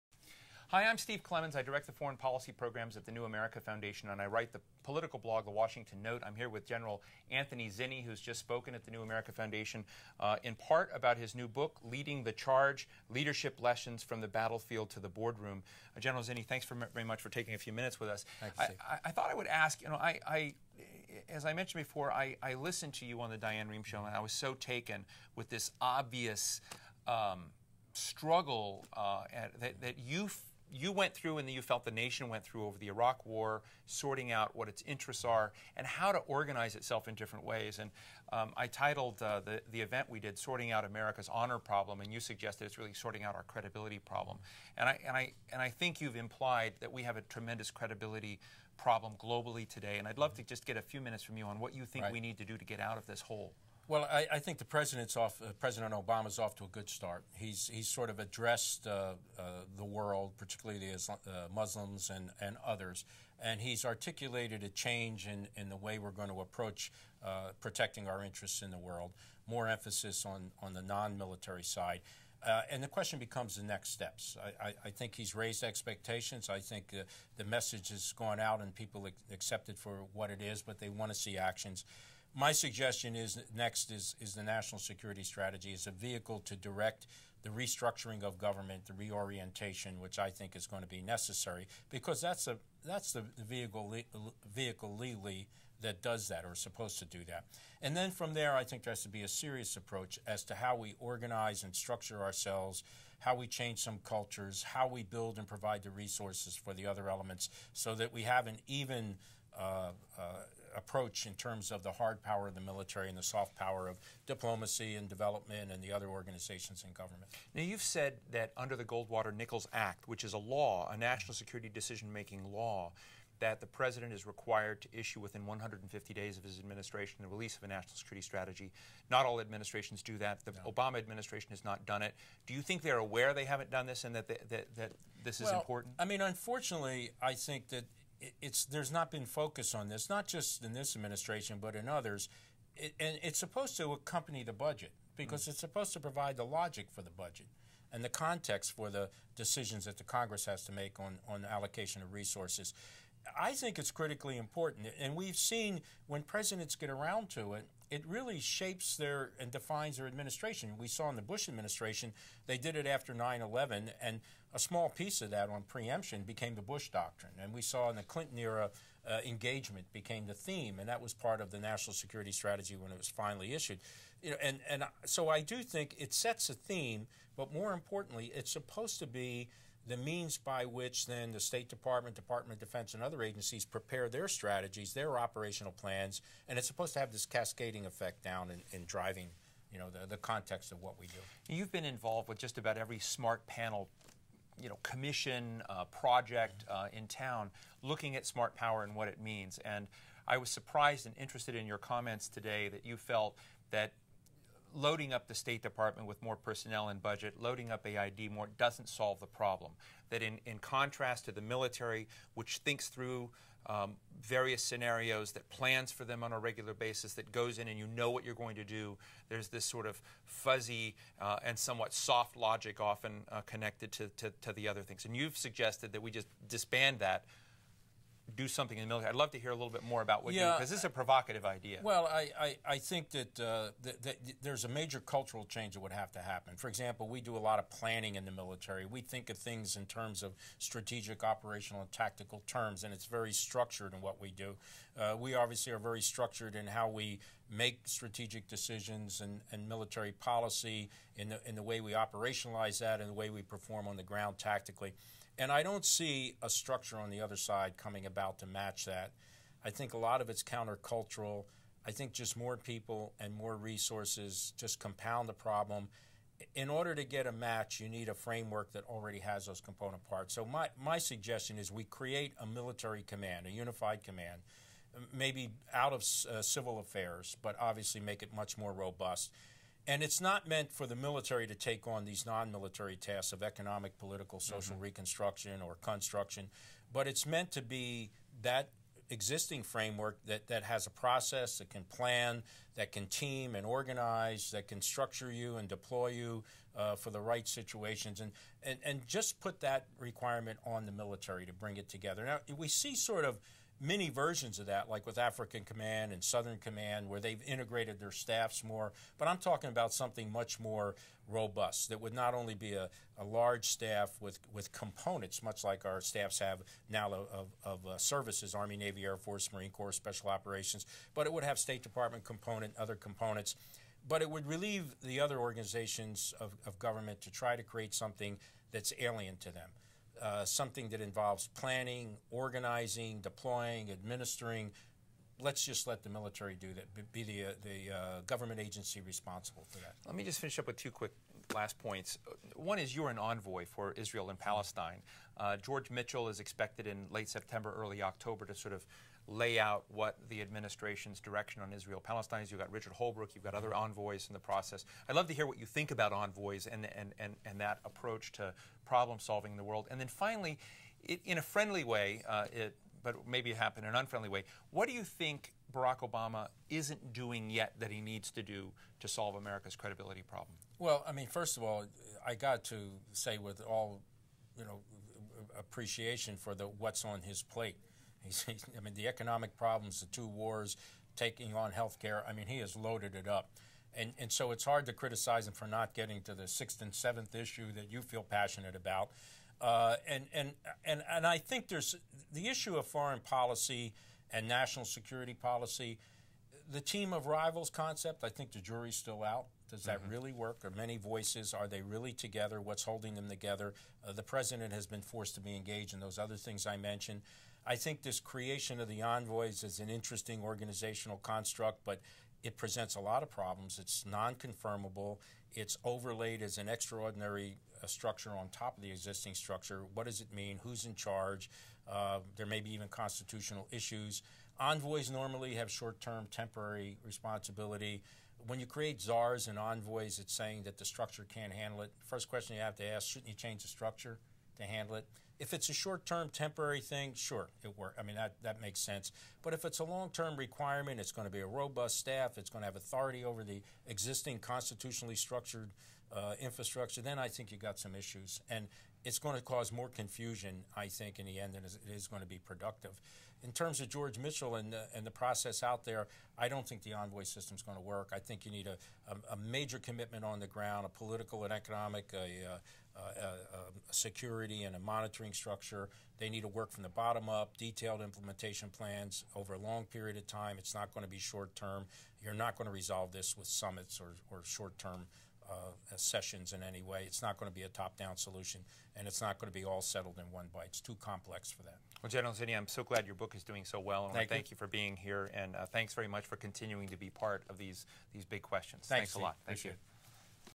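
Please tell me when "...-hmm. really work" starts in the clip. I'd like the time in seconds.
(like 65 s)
400 s.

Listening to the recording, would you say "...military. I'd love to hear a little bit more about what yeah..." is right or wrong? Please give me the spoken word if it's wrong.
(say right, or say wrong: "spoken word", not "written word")
right.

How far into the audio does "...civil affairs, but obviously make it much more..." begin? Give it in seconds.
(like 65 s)
276 s.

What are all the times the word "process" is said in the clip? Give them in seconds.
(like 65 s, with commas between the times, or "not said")
290 s, 354 s, 455 s.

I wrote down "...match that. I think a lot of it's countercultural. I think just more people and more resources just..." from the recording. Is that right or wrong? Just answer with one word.
right.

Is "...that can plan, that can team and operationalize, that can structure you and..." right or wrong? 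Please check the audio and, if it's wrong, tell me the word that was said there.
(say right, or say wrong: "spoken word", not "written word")
wrong: "organize", not "operationalize".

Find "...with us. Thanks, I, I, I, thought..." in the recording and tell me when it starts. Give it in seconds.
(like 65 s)
17 s.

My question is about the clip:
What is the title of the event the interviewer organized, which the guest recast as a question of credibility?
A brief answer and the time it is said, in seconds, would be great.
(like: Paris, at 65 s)
Sorting Out America's Honor Problem, at 40 s.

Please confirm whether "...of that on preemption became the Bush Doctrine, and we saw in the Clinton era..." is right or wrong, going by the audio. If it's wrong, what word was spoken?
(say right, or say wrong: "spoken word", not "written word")
right.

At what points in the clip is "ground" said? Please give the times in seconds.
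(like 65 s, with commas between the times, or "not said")
254 s, 460 s.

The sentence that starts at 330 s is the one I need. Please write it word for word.
Uh, something that involves planning, organizing, deploying, administering.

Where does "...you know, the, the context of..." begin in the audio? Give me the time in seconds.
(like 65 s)
189 s.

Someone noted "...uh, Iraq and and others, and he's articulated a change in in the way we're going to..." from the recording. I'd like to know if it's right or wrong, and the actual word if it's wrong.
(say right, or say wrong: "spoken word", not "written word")
wrong: "Muslims", not "Iraq".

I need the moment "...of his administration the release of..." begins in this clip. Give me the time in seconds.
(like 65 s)
126 s.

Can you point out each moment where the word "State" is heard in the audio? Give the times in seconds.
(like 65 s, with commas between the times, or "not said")
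181 s, 205 s, 321 s.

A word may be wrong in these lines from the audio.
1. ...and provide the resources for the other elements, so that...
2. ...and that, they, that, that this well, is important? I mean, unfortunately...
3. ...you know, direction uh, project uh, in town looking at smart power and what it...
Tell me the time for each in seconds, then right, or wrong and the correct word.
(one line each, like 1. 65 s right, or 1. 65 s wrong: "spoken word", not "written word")
1. 105 s right
2. 134 s right
3. 194 s wrong: "commission", not "direction".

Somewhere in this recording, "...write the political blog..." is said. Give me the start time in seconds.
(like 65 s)
4 s.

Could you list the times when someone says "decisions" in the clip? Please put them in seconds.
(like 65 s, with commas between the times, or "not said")
121 s, 149 s, 248 s.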